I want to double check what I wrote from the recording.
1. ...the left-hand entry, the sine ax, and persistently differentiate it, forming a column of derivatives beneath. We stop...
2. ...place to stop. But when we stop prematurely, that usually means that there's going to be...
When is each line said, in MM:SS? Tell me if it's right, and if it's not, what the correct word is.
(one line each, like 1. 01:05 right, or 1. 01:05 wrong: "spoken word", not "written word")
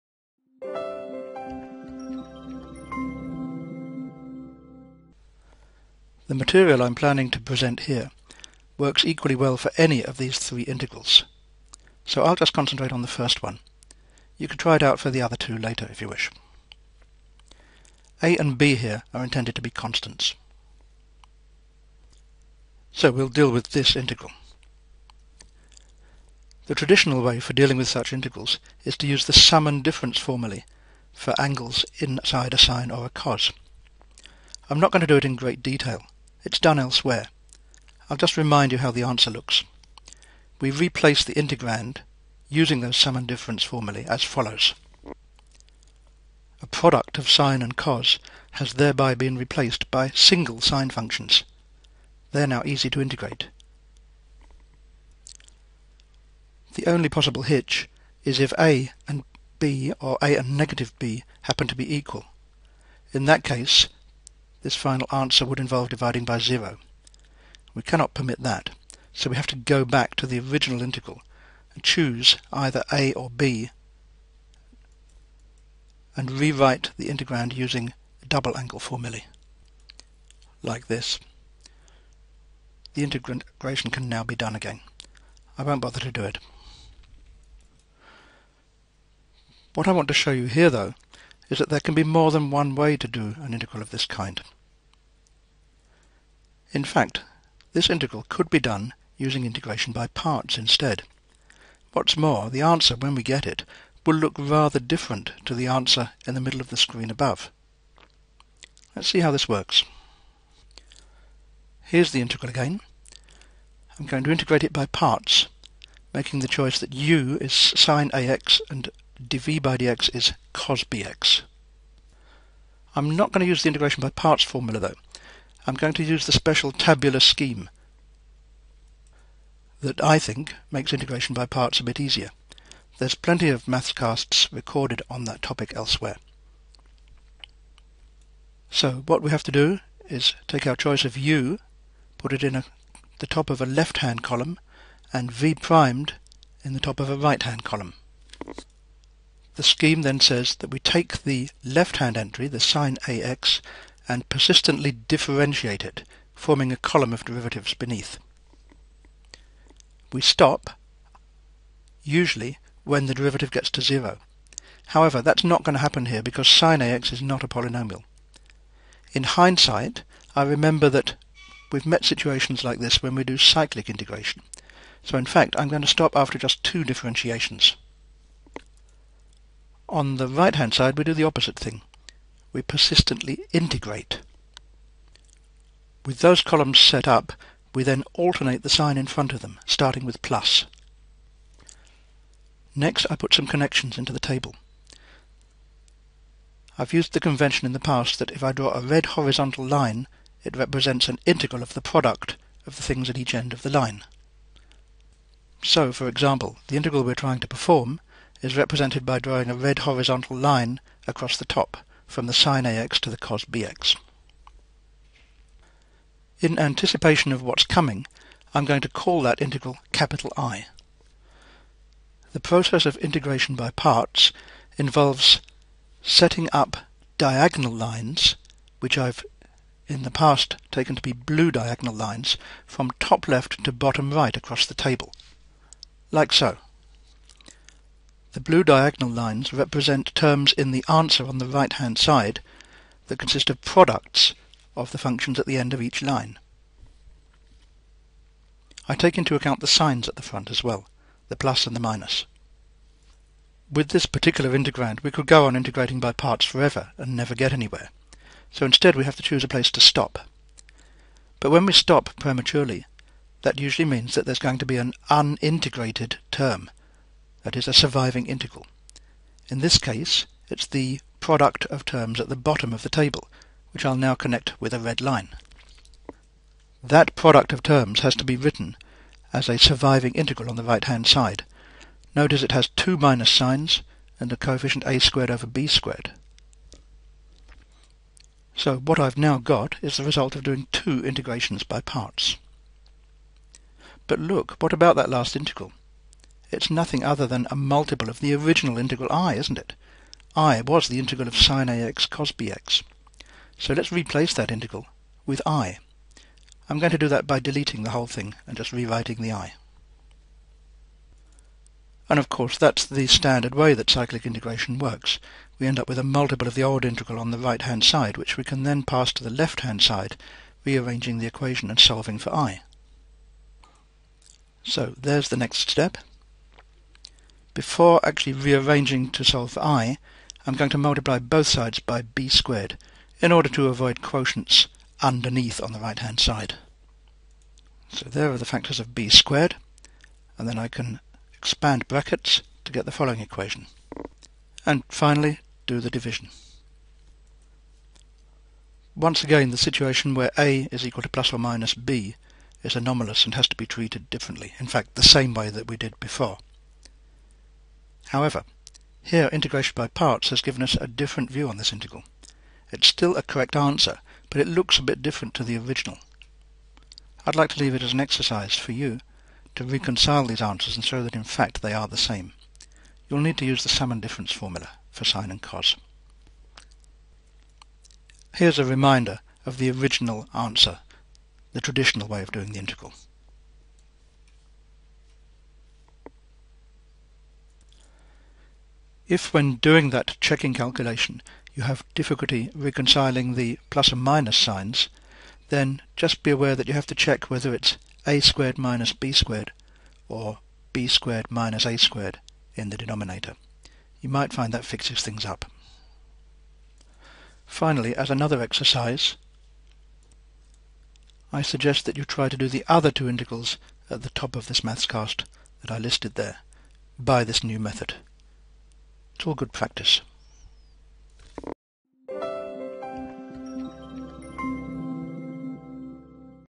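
1. 02:31 right
2. 04:19 right.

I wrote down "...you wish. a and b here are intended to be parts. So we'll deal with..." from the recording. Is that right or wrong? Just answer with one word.
wrong.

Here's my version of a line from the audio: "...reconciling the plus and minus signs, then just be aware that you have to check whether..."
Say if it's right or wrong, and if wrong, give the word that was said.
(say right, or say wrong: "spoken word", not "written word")
right.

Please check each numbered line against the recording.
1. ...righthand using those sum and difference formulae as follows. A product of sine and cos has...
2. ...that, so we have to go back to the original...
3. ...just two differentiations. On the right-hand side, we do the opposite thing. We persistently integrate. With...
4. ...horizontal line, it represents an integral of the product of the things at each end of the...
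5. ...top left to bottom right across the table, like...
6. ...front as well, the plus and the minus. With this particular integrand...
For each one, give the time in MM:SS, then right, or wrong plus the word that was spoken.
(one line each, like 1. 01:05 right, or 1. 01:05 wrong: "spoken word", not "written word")
1. 00:41 wrong: "integrand", not "righthand"
2. 01:08 right
3. 02:56 right
4. 03:19 right
5. 03:52 right
6. 04:10 right.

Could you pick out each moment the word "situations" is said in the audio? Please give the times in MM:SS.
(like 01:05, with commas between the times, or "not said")
02:52, 05:49.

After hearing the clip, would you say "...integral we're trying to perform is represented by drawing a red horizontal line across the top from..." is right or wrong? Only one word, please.
right.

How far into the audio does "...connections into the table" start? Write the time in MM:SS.
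03:13.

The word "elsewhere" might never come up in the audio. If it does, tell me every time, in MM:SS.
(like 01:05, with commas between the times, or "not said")
00:36, 02:15.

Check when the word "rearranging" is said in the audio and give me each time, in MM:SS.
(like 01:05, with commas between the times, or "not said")
05:20, 05:28.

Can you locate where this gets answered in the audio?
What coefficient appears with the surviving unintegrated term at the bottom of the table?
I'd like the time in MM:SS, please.
04:44.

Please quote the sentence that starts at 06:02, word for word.
It's still a correct answer, but it looks a bit different to the original.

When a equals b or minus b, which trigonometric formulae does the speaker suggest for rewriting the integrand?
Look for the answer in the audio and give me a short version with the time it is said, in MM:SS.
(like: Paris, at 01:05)
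Double angle formulae, at 01:18.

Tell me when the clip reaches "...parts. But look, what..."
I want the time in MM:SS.
04:51.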